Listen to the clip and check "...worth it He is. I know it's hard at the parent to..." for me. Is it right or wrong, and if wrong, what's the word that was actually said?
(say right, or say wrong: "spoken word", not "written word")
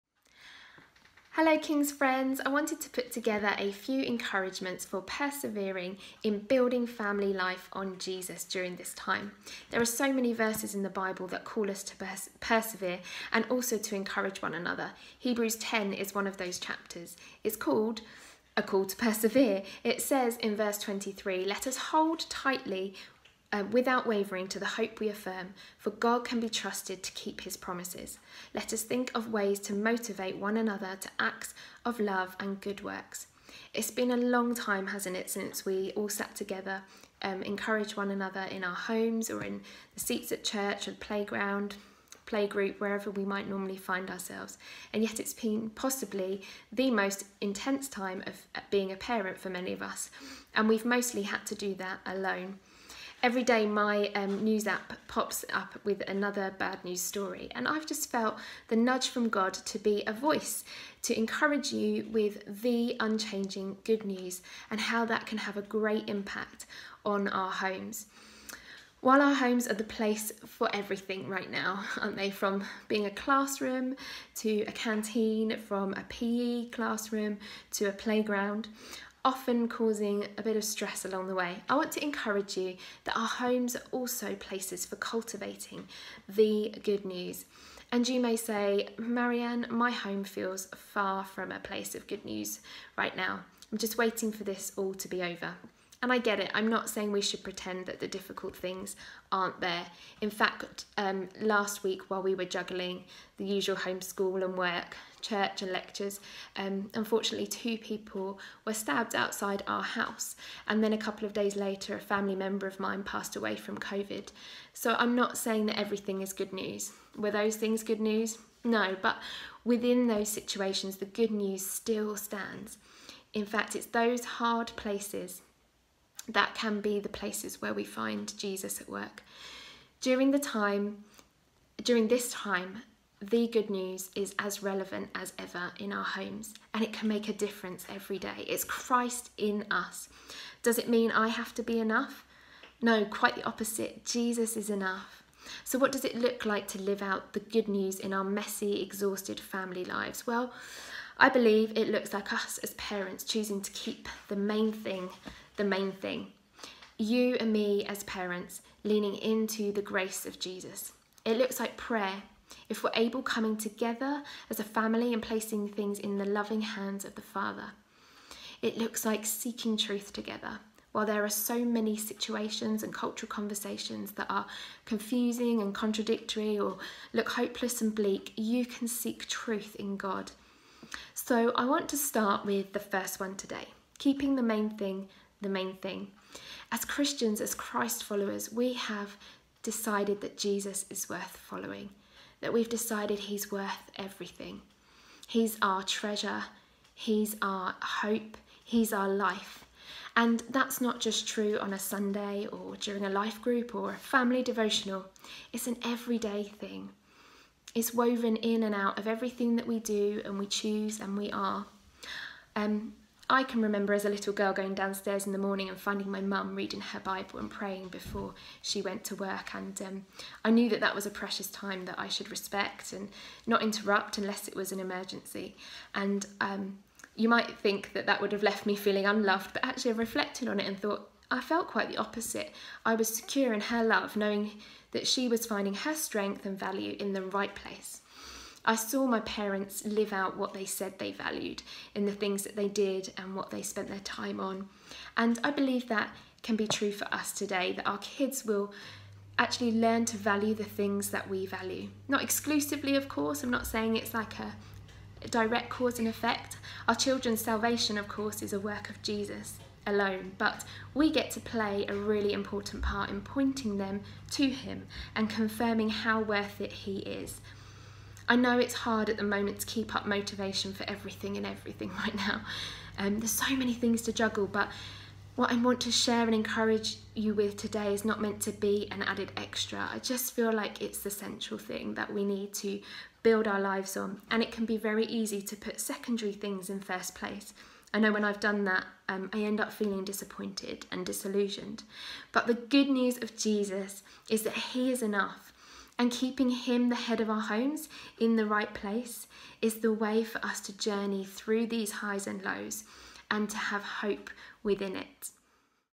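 wrong: "moment", not "parent".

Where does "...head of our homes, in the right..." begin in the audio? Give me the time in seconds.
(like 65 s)
296 s.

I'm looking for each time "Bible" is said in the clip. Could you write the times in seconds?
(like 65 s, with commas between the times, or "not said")
10 s, 216 s.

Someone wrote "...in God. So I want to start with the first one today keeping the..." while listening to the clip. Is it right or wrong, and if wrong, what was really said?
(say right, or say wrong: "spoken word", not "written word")
right.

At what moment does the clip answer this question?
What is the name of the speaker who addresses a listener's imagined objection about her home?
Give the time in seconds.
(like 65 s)
88 s.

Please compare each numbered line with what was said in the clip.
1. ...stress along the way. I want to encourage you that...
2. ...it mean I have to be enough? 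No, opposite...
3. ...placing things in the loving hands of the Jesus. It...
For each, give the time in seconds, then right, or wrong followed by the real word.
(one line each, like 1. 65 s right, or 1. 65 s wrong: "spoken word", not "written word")
1. 80 s right
2. 140 s wrong: "quite", not "opposite"
3. 165 s wrong: "Father", not "Jesus".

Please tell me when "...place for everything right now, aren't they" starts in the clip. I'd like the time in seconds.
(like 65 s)
69 s.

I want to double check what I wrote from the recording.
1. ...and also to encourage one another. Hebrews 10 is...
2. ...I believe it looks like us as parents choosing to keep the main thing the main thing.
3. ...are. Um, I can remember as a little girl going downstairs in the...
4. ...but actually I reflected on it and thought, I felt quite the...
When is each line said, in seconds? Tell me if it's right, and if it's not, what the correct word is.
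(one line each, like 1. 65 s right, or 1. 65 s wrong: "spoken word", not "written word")
1. 13 s right
2. 151 s right
3. 211 s right
4. 229 s right.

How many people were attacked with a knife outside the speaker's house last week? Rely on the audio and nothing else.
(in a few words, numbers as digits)
2.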